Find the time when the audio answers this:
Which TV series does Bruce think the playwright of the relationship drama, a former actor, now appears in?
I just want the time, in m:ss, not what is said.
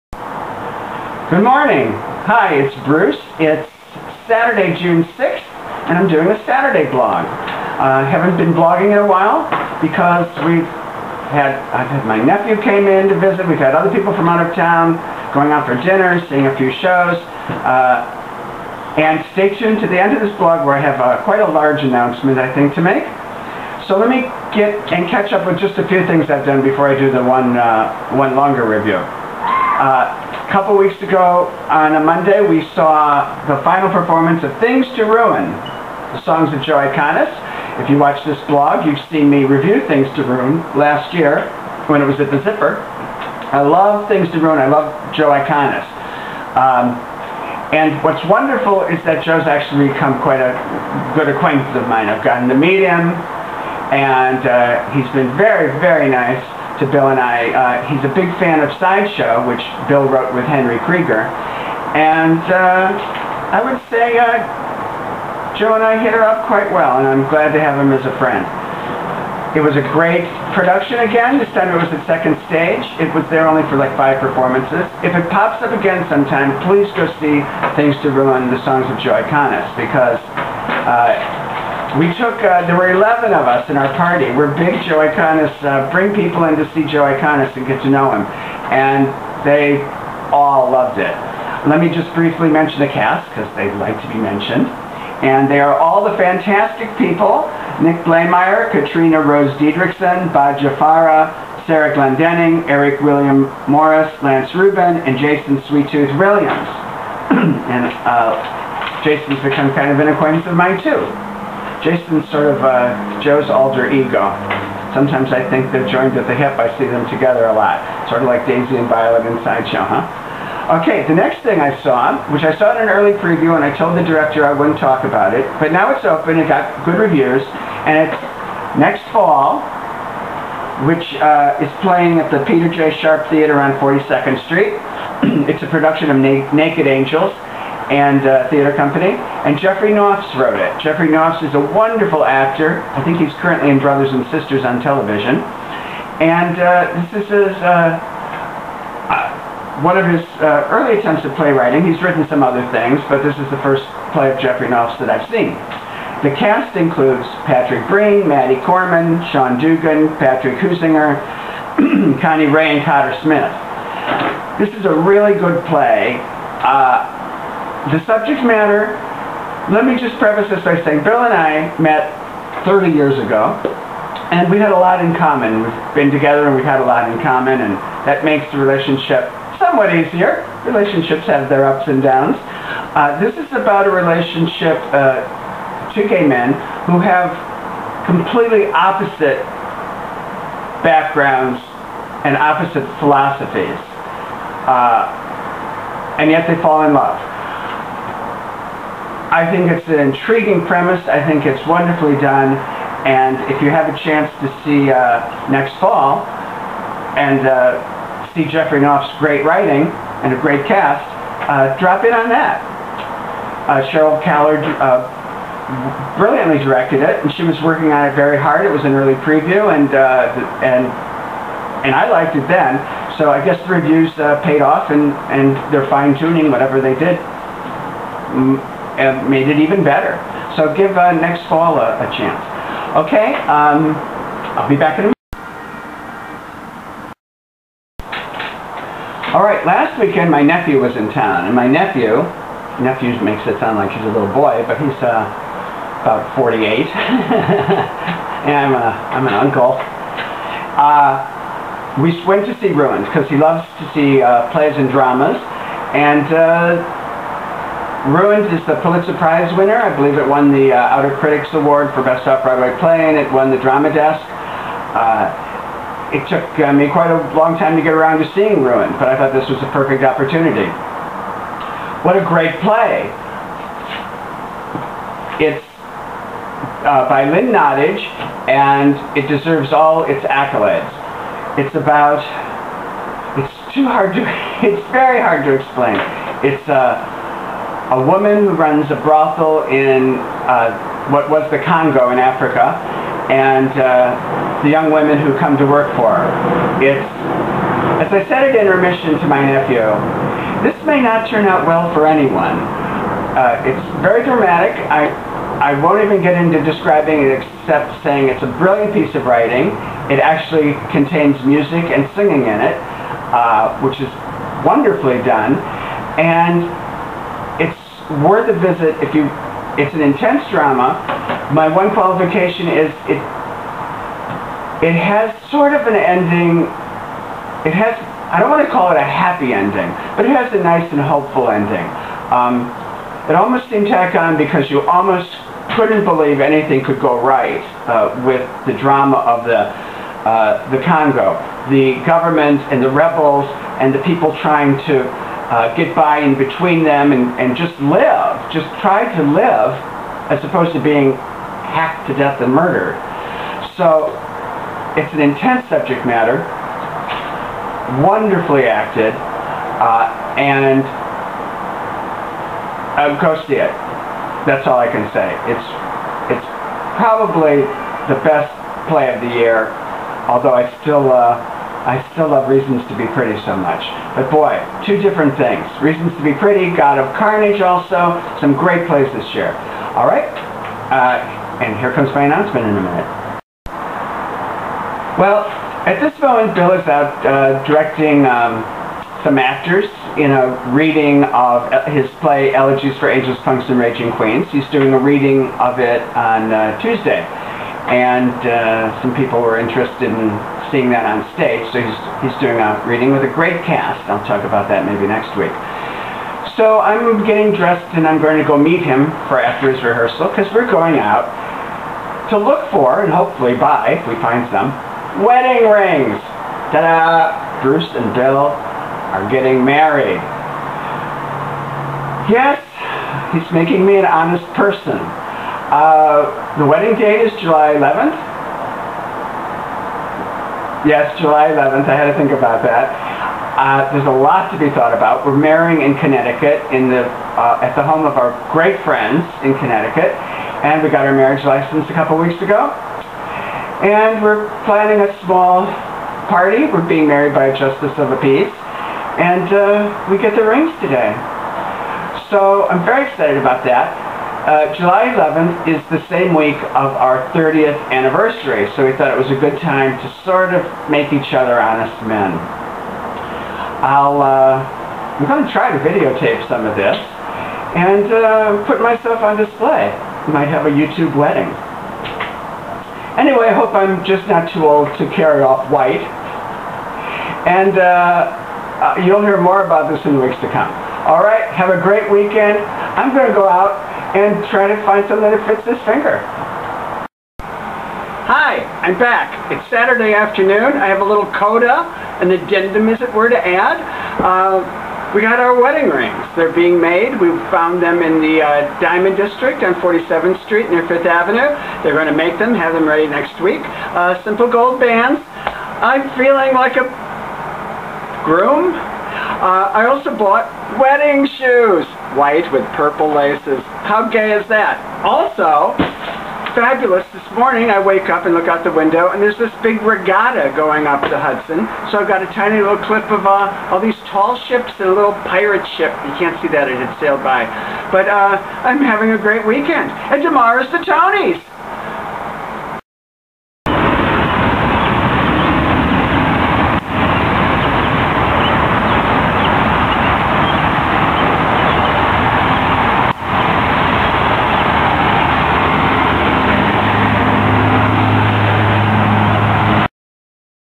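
2:23.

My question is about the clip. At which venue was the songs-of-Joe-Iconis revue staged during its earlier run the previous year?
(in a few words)
the Zipper.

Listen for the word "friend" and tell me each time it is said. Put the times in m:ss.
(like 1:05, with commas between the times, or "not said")
1:08, 7:18.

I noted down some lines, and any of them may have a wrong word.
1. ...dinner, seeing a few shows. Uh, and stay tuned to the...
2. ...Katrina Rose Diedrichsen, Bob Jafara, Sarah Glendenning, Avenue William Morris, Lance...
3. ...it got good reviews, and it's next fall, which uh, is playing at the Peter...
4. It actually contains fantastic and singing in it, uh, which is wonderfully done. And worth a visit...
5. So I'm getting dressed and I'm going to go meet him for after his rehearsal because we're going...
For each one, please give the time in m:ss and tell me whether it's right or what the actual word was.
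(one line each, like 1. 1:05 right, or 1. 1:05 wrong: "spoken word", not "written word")
1. 0:15 right
2. 1:38 wrong: "Eric", not "Avenue"
3. 2:06 right
4. 5:10 wrong: "music", not "fantastic"
5. 6:46 right.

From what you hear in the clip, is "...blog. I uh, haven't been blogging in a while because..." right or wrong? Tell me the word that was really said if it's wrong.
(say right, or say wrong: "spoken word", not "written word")
right.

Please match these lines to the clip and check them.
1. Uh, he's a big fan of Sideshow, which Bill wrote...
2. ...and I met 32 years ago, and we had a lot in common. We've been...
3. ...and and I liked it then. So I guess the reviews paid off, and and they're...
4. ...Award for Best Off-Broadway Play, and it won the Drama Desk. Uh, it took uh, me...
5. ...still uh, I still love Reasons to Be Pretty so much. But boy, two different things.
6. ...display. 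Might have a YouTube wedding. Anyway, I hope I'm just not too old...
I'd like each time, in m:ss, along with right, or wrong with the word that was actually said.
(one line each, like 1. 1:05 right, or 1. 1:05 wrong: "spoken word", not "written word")
1. 0:57 right
2. 2:51 wrong: "30", not "32"
3. 3:40 right
4. 4:21 right
5. 6:10 right
6. 7:49 right.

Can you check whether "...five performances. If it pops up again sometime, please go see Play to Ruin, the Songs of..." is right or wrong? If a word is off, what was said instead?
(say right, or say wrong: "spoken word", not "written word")
wrong: "Things", not "Play".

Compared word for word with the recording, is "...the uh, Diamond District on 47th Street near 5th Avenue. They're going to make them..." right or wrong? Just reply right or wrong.
right.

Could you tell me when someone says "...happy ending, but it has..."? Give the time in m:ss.
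5:29.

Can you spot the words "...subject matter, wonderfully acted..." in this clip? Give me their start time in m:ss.
5:55.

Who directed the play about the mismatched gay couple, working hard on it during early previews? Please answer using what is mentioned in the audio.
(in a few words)
Sheryl Kaller.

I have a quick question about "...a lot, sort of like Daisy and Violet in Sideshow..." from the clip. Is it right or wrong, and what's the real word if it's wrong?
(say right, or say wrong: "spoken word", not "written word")
right.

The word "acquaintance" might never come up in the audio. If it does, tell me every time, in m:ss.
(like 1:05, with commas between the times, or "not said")
0:51, 1:50.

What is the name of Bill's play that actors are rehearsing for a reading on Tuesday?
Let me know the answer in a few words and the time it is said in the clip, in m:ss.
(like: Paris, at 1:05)
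Elegies for Angels, Punks and Raging Queens, at 6:32.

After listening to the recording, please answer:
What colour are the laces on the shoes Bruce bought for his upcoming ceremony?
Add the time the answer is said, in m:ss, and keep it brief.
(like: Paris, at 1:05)
purple, at 8:32.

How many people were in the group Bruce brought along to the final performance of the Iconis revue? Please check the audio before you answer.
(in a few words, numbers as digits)
11.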